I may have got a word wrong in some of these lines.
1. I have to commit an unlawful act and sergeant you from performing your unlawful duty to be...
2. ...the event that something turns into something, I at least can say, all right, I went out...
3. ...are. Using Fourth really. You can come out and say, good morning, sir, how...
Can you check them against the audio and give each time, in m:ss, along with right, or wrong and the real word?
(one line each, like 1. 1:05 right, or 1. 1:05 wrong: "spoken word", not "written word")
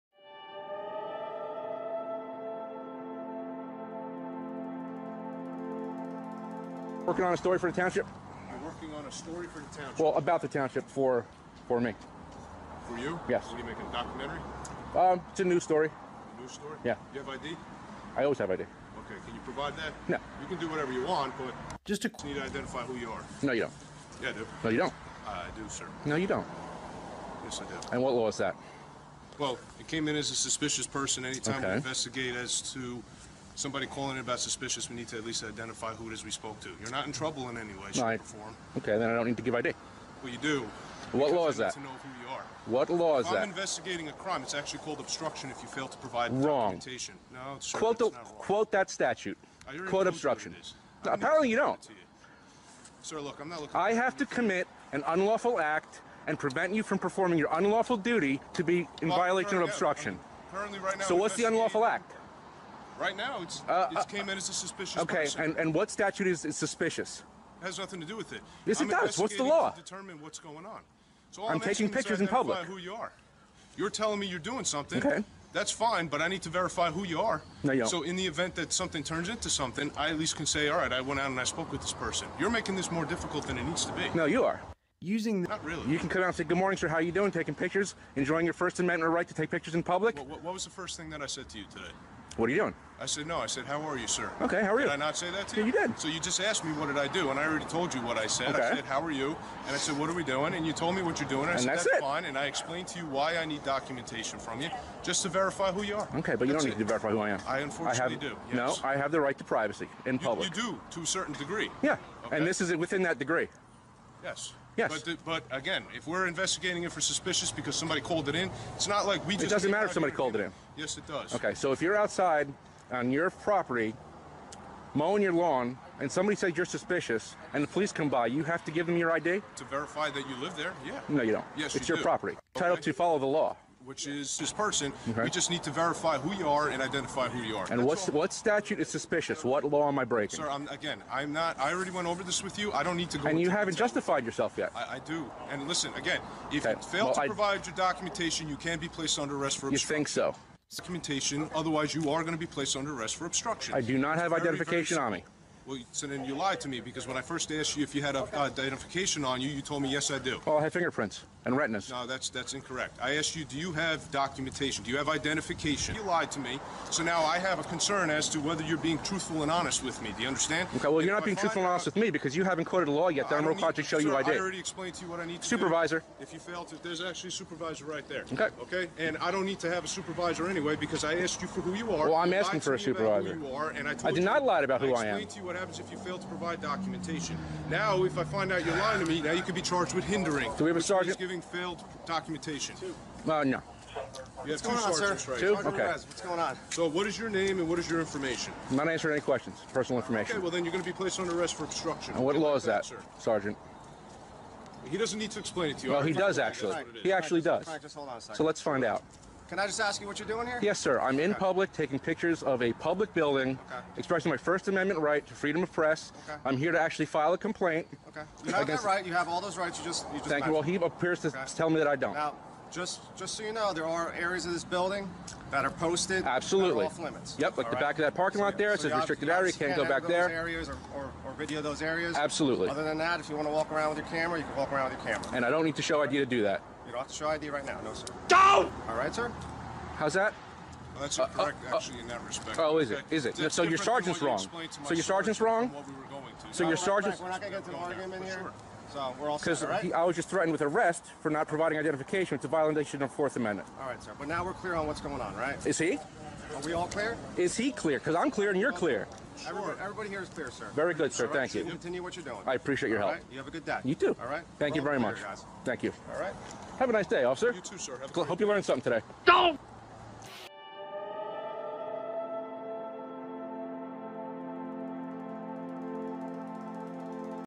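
1. 0:53 wrong: "prevent", not "sergeant"
2. 1:18 right
3. 1:24 wrong: "Not", not "Fourth".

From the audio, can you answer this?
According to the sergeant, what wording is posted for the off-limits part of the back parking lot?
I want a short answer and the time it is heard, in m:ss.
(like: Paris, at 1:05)
Restricted area, at 3:48.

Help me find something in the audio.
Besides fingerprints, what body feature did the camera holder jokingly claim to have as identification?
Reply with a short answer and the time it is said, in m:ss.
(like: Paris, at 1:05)
Retinas, at 2:41.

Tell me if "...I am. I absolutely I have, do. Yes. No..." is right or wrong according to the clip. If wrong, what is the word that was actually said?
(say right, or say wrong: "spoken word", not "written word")
wrong: "unfortunately", not "absolutely".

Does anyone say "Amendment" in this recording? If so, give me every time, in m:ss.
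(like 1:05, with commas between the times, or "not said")
1:28, 3:34, 4:13.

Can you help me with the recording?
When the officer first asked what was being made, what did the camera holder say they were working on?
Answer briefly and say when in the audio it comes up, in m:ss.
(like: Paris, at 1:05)
A news story, at 0:15.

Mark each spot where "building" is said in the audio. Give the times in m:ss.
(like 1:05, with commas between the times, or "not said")
3:33, 3:44.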